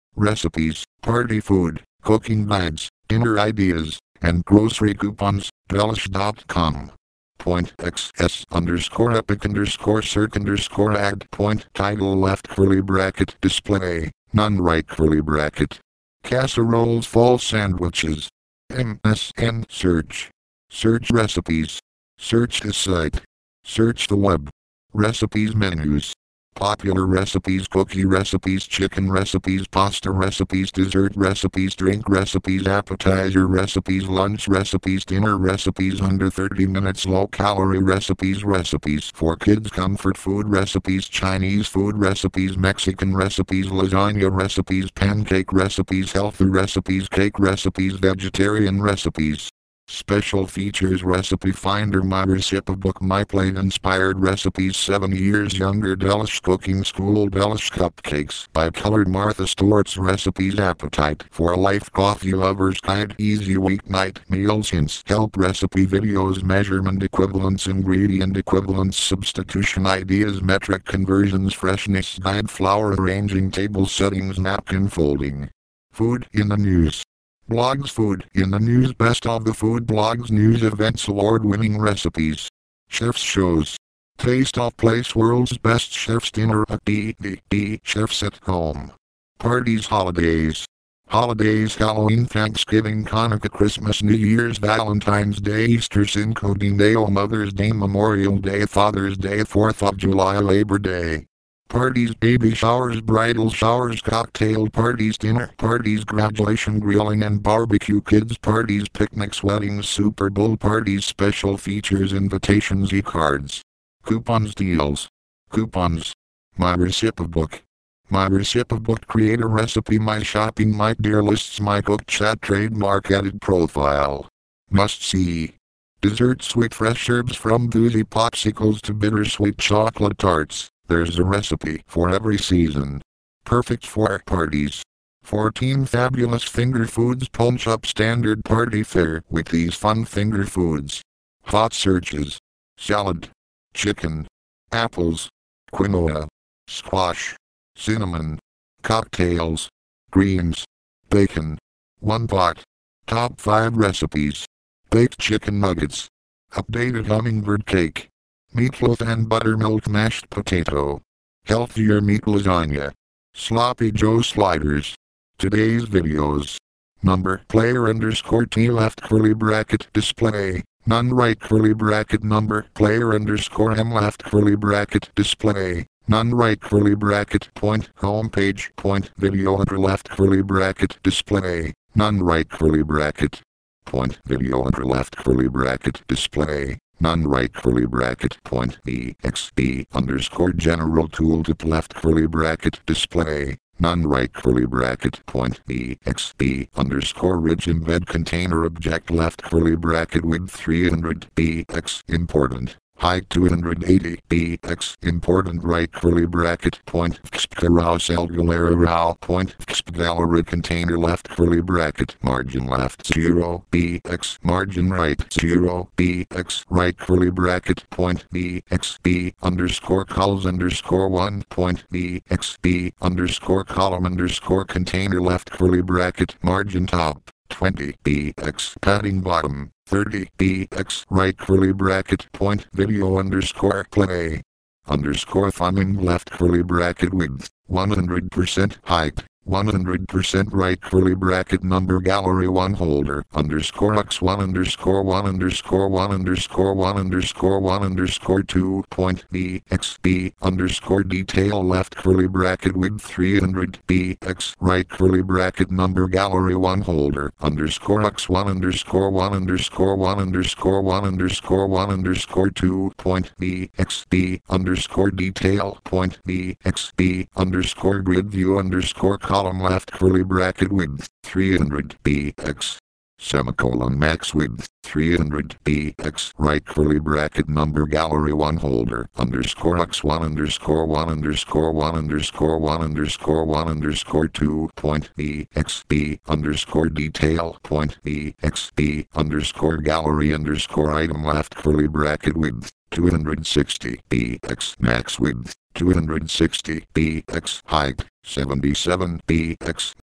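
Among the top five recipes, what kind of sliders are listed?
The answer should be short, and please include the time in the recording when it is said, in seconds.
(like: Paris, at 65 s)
Sloppy Joe, at 163 s.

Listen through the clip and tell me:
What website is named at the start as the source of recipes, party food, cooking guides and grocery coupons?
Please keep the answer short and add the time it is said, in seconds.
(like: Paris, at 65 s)
Delish.com, at 5 s.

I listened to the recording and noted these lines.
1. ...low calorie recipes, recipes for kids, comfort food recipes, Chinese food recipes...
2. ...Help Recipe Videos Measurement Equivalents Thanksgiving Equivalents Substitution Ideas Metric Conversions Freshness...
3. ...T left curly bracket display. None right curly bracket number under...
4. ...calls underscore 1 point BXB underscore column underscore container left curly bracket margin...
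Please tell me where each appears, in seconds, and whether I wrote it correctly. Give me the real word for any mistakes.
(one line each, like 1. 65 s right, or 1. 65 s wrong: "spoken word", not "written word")
1. 37 s right
2. 65 s wrong: "Ingredient", not "Thanksgiving"
3. 168 s wrong: "player", not "under"
4. 220 s right.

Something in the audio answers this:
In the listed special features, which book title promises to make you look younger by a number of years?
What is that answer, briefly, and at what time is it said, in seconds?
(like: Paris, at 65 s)
7 Years Younger, at 54 s.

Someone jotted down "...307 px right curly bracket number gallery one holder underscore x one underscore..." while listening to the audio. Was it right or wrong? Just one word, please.
wrong.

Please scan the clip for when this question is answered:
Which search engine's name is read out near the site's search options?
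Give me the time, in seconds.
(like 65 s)
18 s.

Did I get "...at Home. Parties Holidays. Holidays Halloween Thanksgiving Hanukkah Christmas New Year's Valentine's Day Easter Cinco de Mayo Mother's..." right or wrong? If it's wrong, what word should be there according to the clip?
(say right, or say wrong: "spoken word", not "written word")
right.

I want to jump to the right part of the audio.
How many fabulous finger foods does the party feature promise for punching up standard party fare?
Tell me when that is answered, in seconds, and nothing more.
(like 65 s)
135 s.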